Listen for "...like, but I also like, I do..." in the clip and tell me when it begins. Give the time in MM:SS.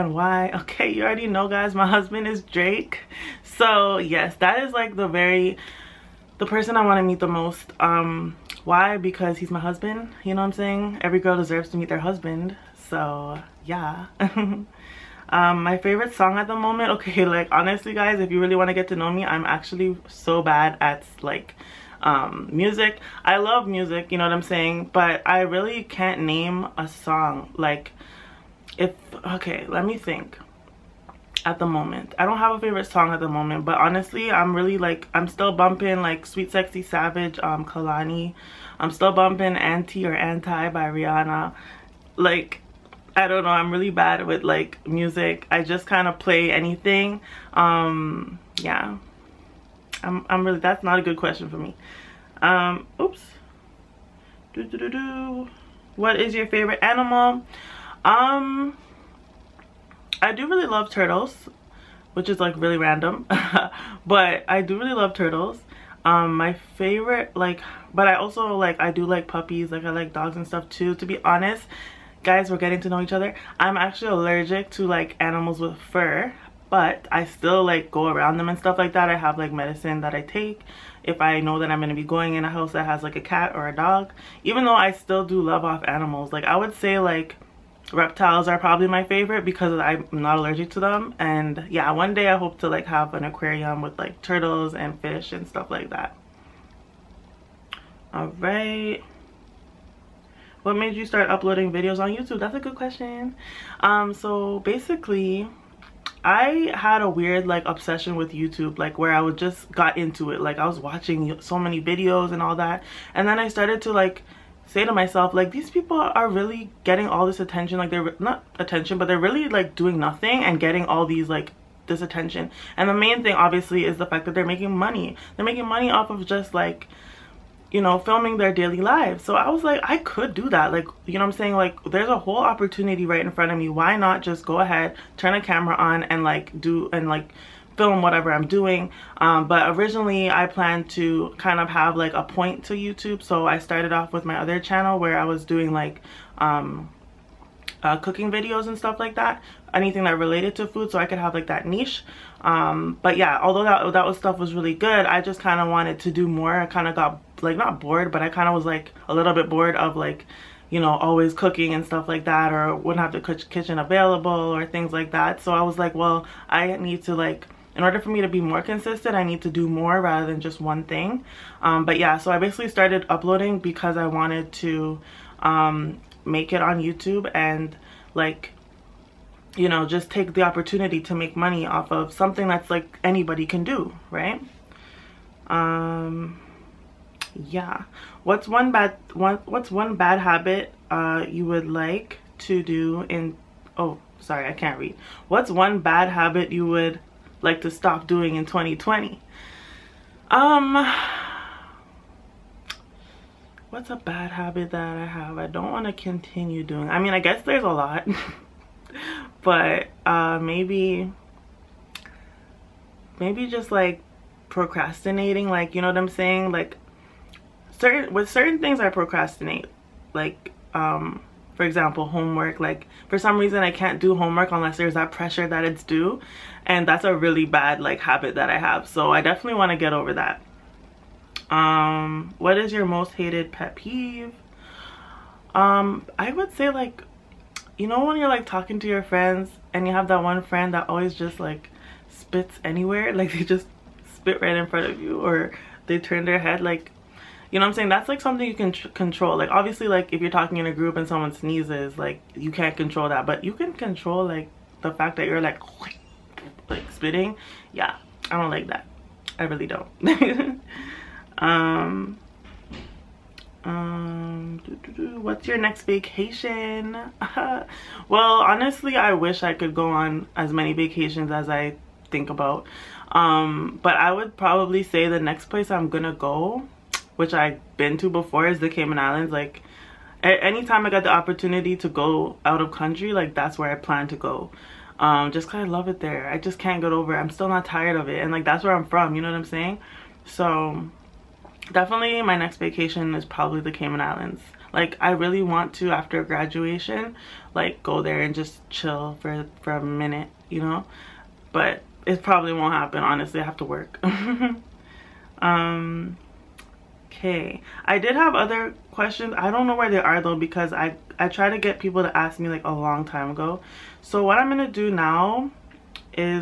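01:07.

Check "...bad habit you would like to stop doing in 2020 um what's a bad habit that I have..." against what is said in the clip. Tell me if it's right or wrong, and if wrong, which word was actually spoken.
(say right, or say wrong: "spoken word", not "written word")
right.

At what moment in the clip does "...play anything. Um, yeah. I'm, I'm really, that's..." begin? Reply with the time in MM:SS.
00:46.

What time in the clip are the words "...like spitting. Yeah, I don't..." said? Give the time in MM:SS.
04:16.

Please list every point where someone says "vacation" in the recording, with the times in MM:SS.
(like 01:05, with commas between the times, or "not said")
04:25, 04:30, 04:52.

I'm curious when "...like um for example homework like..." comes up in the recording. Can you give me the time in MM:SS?
03:40.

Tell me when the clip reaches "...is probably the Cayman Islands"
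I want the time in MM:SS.
04:53.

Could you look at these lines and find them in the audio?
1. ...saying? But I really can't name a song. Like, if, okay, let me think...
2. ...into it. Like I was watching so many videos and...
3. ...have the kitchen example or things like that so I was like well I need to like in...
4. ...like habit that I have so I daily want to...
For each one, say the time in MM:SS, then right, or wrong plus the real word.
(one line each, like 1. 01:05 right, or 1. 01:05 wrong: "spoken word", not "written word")
1. 00:24 right
2. 01:49 right
3. 02:43 wrong: "available", not "example"
4. 03:47 wrong: "definitely", not "daily".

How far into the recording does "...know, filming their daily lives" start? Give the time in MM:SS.
02:07.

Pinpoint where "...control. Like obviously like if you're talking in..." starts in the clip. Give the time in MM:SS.
04:08.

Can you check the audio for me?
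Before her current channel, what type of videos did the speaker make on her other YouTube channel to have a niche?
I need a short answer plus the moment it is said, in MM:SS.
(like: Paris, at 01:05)
Cooking videos, at 02:27.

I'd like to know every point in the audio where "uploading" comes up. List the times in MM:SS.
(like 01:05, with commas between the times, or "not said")
01:41, 02:53.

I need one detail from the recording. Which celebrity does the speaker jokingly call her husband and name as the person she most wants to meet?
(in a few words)
Drake.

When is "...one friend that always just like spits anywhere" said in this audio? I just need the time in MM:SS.
04:00.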